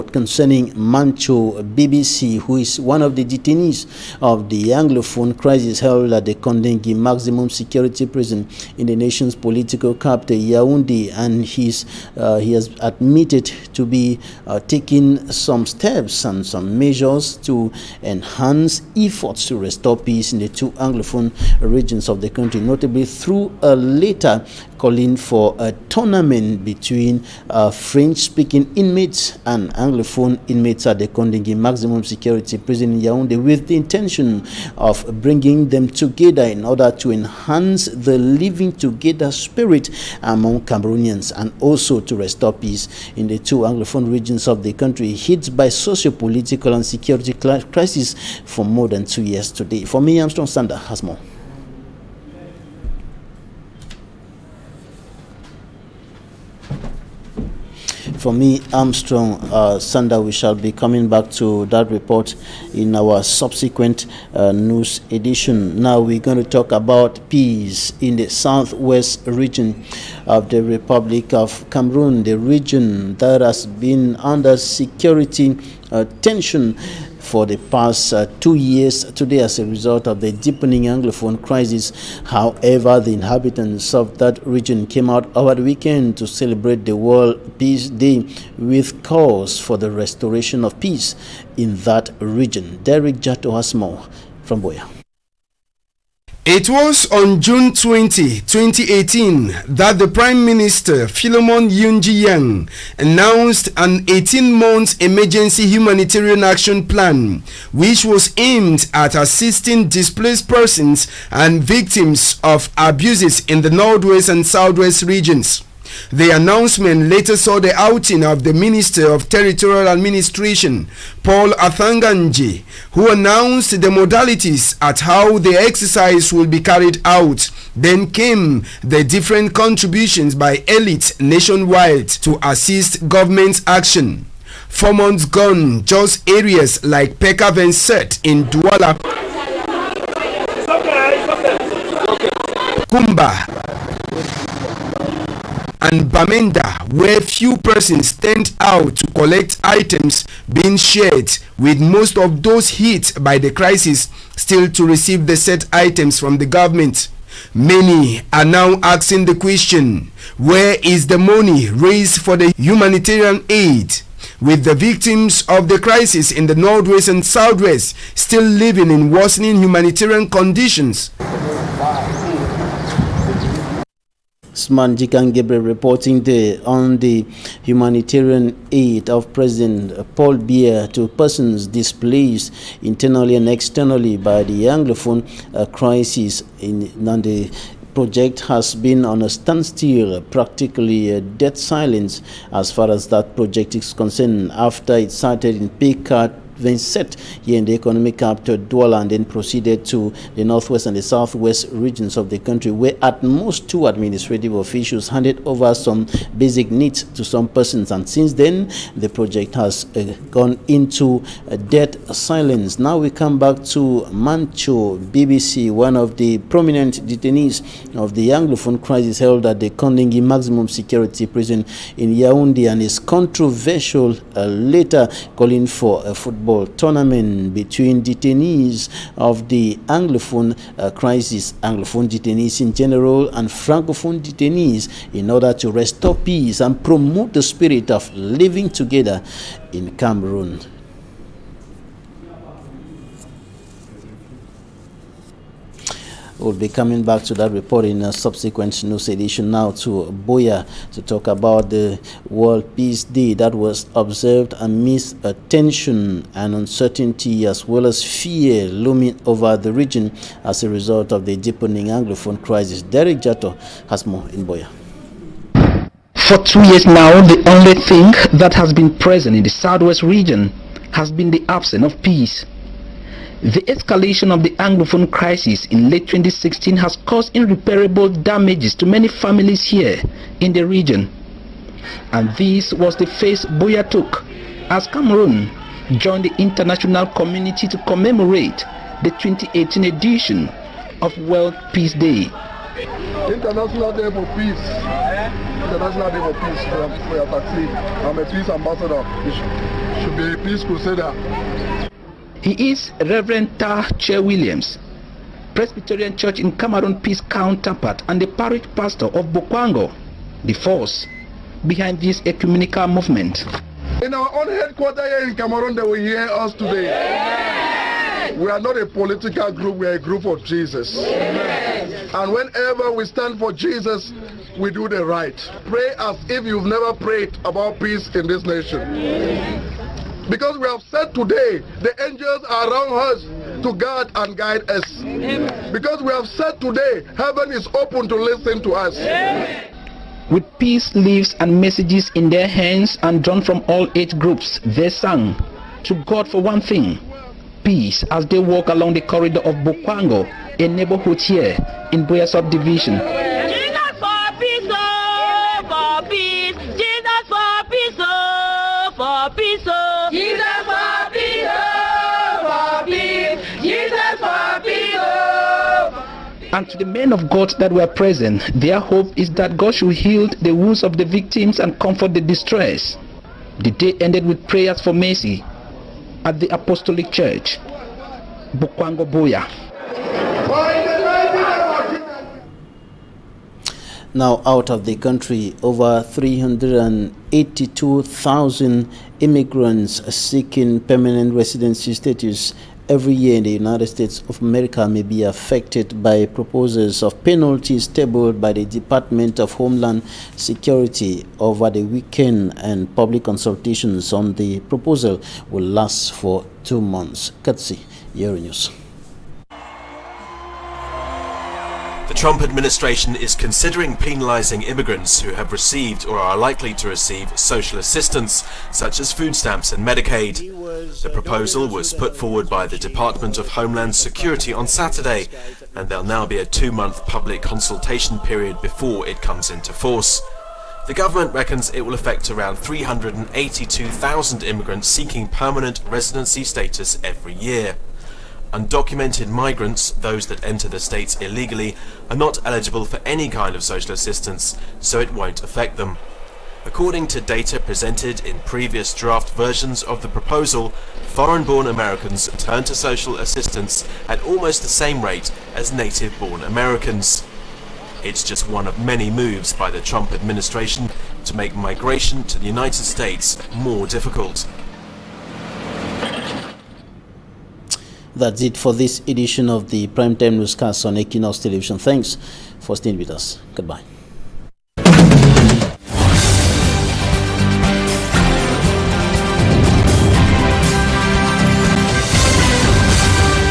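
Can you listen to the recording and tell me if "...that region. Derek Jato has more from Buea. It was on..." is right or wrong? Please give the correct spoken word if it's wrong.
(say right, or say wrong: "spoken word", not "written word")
right.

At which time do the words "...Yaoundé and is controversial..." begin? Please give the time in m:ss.
3:42.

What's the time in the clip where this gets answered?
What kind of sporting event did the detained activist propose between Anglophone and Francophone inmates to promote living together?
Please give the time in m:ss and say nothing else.
3:46.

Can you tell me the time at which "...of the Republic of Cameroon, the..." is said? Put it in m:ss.
1:10.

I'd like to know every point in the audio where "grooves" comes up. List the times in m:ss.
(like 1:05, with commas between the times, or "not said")
not said.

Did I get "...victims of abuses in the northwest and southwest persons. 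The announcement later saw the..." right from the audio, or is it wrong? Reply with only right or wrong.
wrong.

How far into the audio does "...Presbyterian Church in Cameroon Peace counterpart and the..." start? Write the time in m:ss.
5:05.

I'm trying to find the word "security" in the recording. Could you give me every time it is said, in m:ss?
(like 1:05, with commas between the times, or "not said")
0:07, 0:32, 0:46, 1:14, 3:40, 6:40, 7:03.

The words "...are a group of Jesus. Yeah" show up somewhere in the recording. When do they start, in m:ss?
5:19.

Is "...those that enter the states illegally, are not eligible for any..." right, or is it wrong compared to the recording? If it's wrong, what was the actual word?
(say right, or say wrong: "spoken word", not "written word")
right.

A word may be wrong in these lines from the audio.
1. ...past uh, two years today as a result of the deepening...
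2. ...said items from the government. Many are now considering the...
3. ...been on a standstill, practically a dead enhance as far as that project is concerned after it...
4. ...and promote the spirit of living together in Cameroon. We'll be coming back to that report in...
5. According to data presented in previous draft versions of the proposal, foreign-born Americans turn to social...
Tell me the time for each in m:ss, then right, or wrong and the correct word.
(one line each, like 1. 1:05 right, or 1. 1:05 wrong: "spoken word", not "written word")
1. 1:17 right
2. 2:35 wrong: "asking", not "considering"
3. 3:08 wrong: "silence", not "enhance"
4. 3:56 right
5. 7:26 right.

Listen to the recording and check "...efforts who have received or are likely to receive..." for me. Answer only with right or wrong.
wrong.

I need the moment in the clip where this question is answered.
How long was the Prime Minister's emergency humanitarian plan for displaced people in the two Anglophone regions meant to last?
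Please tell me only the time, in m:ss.
1:44.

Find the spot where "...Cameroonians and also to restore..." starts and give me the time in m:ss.
0:40.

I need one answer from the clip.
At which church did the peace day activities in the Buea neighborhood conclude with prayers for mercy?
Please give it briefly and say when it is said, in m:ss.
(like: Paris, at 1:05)
Apostolic Church, at 6:16.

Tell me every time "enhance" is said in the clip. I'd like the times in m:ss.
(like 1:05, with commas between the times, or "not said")
0:18, 0:37.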